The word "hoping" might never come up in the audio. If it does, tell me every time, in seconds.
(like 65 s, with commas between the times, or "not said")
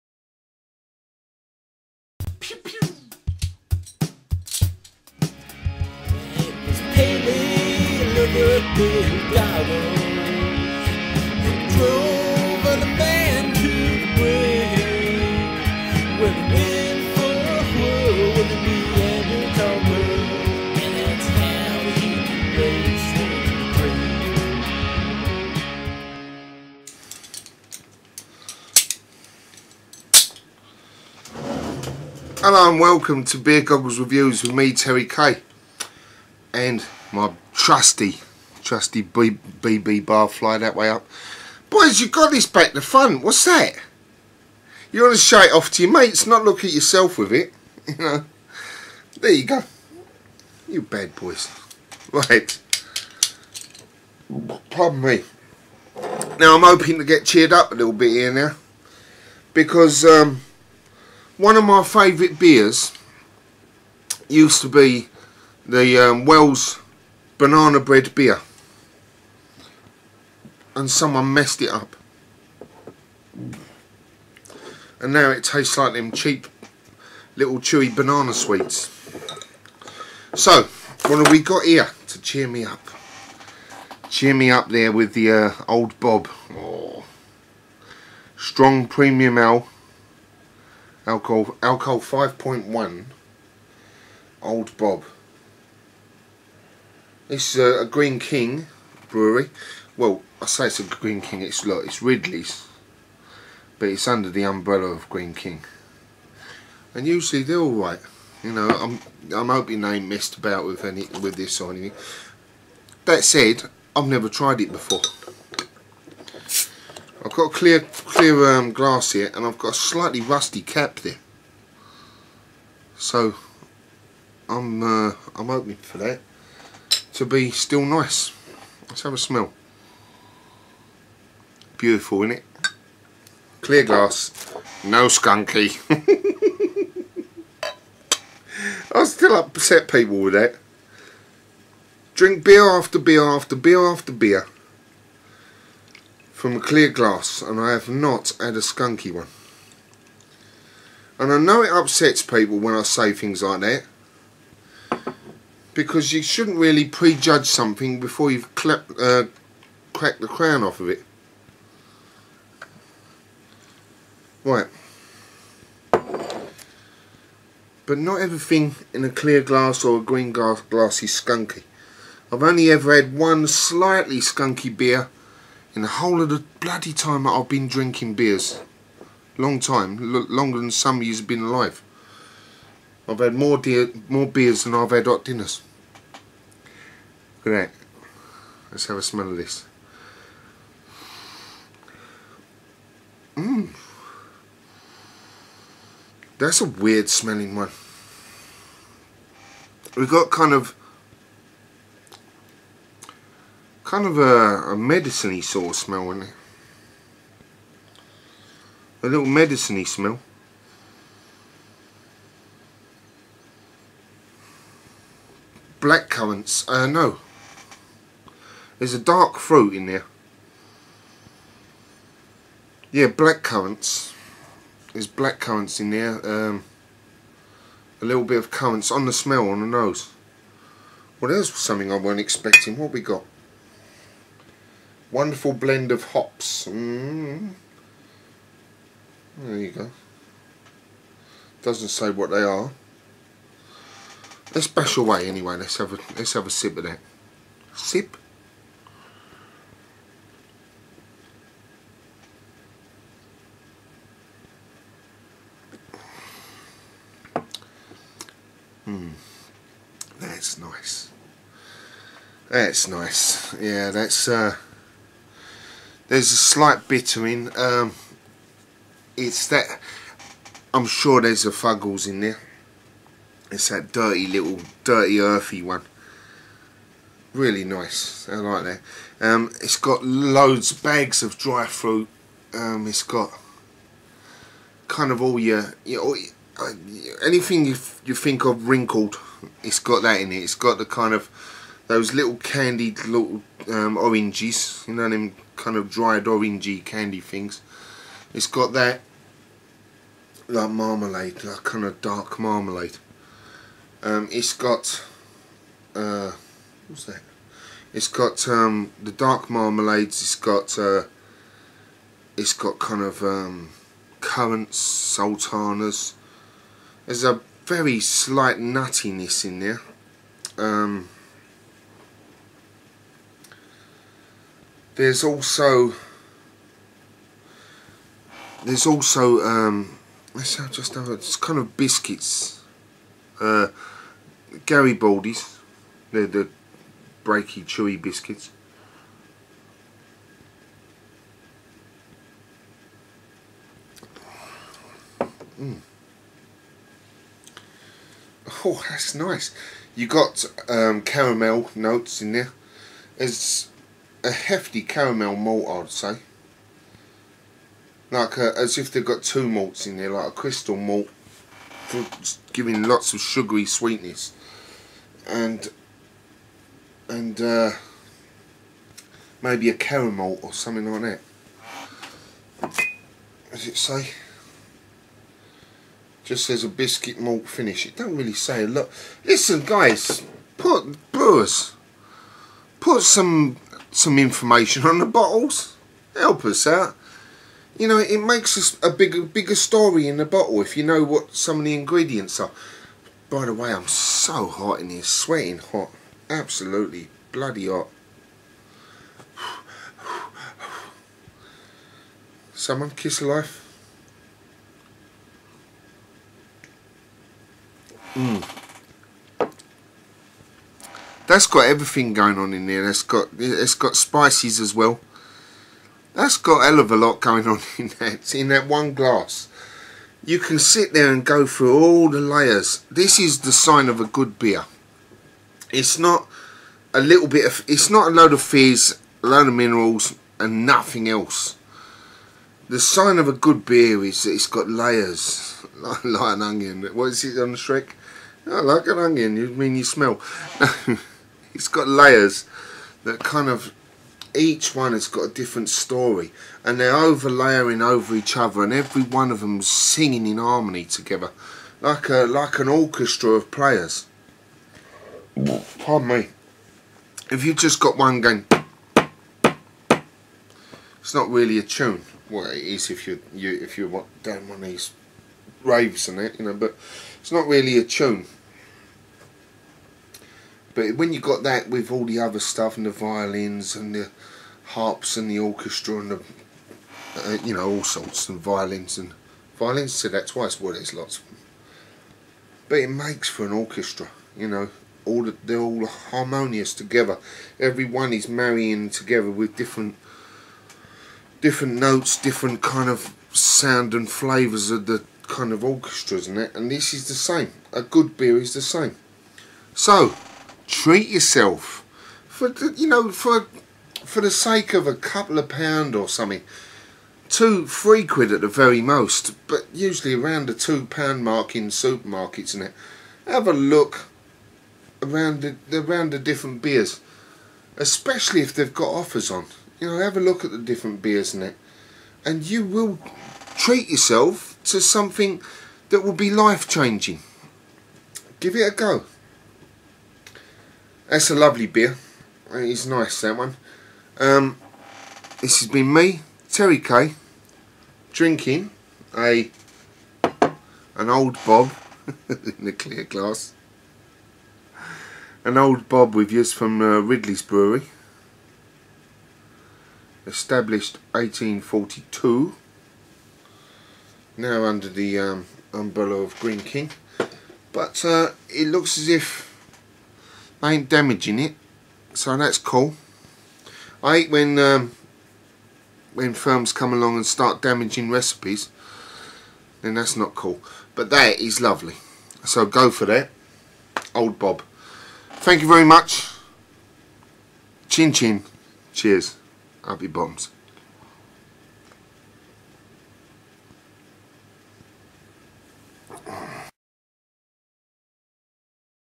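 56 s, 109 s, 125 s.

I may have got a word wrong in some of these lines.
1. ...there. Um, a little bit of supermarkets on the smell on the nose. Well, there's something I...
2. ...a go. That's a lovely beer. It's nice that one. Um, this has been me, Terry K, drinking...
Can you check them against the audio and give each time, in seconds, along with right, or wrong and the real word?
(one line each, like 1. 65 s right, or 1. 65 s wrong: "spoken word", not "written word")
1. 225 s wrong: "currants", not "supermarkets"
2. 528 s right.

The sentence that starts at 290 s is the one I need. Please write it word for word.
It's got the kind of those little candied little um, oranges, you know, them kind of dried orangey candy things.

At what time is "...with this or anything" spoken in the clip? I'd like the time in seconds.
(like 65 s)
111 s.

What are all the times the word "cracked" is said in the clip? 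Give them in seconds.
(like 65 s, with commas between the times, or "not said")
159 s.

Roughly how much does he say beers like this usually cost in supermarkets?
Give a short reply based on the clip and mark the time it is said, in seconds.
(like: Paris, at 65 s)
£2, at 510 s.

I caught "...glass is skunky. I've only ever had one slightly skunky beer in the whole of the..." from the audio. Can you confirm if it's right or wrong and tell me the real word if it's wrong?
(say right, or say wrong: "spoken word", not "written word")
right.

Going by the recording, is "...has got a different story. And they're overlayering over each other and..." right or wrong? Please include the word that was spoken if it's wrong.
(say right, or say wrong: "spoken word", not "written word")
right.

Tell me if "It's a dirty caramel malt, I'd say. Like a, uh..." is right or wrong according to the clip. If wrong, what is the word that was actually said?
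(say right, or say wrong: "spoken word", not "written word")
wrong: "hefty", not "dirty".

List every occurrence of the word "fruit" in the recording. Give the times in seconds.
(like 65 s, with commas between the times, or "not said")
219 s, 281 s.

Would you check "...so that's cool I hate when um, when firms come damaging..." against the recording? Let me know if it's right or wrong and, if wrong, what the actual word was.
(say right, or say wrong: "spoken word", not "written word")
wrong: "along", not "damaging".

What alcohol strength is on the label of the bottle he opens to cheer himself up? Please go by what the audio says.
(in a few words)
5.1.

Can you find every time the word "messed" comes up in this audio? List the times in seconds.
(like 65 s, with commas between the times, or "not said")
71 s, 110 s.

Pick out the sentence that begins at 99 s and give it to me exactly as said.
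Well, I say it's a Greene King, it's look, it's Ridley's, but it's under the umbrella of Greene King.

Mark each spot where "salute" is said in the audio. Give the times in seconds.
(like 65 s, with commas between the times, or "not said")
not said.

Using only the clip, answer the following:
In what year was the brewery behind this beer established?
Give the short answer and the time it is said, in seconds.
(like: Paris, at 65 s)
1842, at 551 s.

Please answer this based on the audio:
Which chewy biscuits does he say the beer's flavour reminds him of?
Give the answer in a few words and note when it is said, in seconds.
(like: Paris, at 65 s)
Garibaldi, at 334 s.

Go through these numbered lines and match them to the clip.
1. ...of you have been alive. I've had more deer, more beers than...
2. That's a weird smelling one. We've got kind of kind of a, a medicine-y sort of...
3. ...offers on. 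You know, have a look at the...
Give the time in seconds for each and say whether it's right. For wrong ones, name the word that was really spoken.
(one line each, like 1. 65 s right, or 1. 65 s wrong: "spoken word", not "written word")
1. 180 s right
2. 196 s right
3. 518 s right.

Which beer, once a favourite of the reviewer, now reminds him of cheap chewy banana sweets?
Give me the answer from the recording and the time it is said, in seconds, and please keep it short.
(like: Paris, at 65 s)
Wells Banana Bread Beer, at 66 s.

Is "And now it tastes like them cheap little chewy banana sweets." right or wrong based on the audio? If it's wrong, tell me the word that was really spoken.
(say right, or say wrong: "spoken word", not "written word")
right.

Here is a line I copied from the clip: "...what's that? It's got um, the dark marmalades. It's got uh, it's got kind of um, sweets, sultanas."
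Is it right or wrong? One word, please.
wrong.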